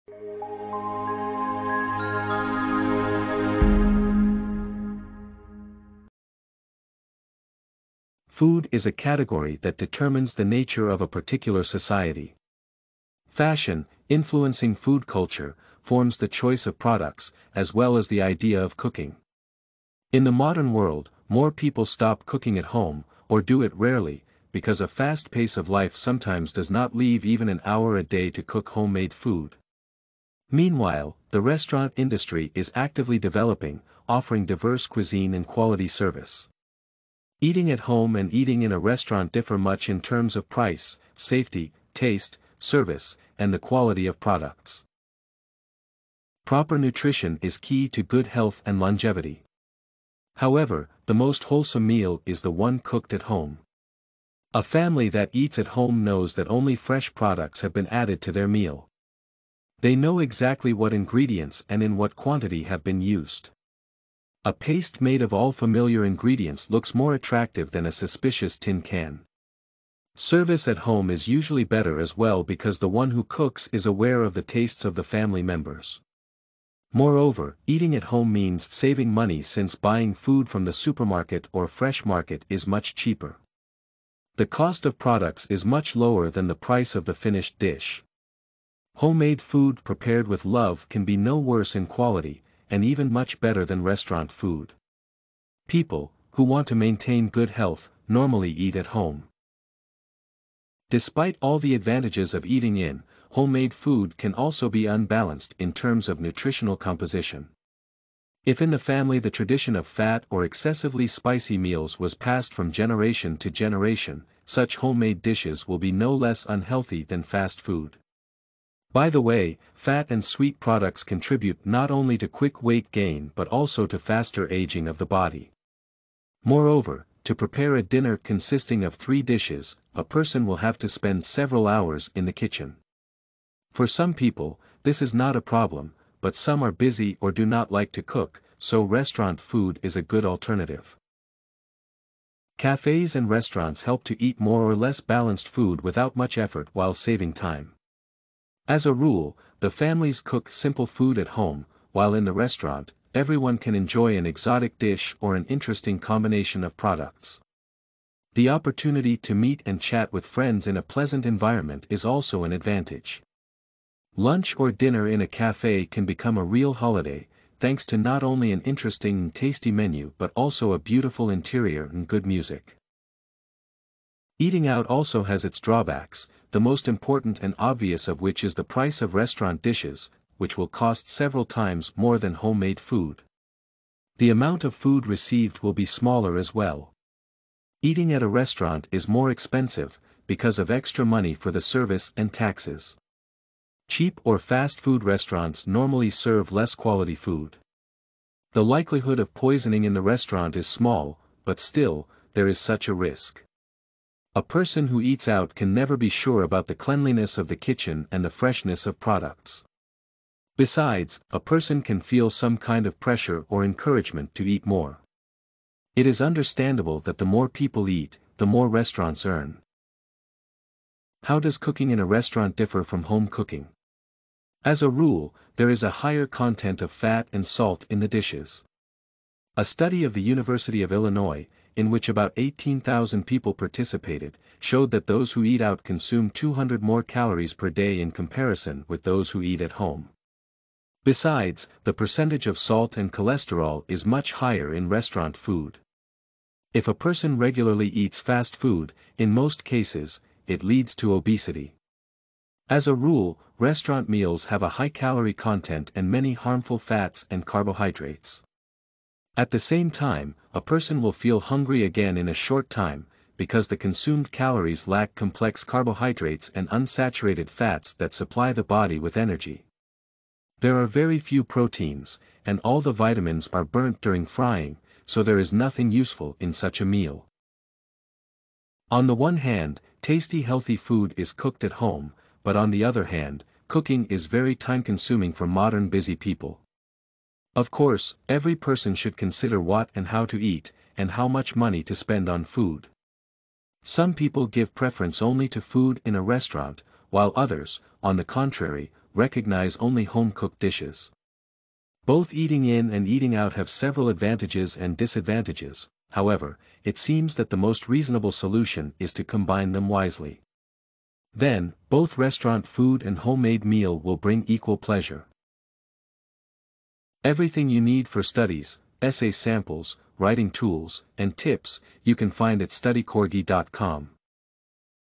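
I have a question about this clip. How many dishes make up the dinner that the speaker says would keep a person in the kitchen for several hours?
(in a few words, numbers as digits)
3.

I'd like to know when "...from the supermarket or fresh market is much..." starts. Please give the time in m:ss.
1:20.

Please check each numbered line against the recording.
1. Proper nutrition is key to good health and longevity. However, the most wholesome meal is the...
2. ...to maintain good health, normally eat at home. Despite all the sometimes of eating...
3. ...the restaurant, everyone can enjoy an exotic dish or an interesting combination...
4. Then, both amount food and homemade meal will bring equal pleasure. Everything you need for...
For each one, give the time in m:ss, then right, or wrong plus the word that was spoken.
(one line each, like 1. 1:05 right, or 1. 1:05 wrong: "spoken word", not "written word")
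1. 0:46 right
2. 1:36 wrong: "advantages", not "sometimes"
3. 2:32 right
4. 5:11 wrong: "restaurant", not "amount".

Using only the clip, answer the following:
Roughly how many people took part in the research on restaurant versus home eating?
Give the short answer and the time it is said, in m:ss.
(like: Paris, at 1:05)
18,000, at 3:52.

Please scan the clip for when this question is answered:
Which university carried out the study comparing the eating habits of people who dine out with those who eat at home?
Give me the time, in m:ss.
3:50.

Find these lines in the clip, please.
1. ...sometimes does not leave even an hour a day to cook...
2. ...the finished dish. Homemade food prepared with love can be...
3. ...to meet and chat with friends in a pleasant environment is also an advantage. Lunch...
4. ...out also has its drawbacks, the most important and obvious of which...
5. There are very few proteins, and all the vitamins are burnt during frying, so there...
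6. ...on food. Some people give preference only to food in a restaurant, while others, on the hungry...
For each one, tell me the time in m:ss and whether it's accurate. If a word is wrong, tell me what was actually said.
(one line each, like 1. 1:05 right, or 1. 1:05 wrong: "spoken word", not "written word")
1. 0:25 right
2. 1:27 right
3. 2:39 right
4. 2:54 right
5. 4:30 right
6. 4:52 wrong: "contrary", not "hungry".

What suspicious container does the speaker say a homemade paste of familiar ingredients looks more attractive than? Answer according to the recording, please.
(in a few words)
tin can.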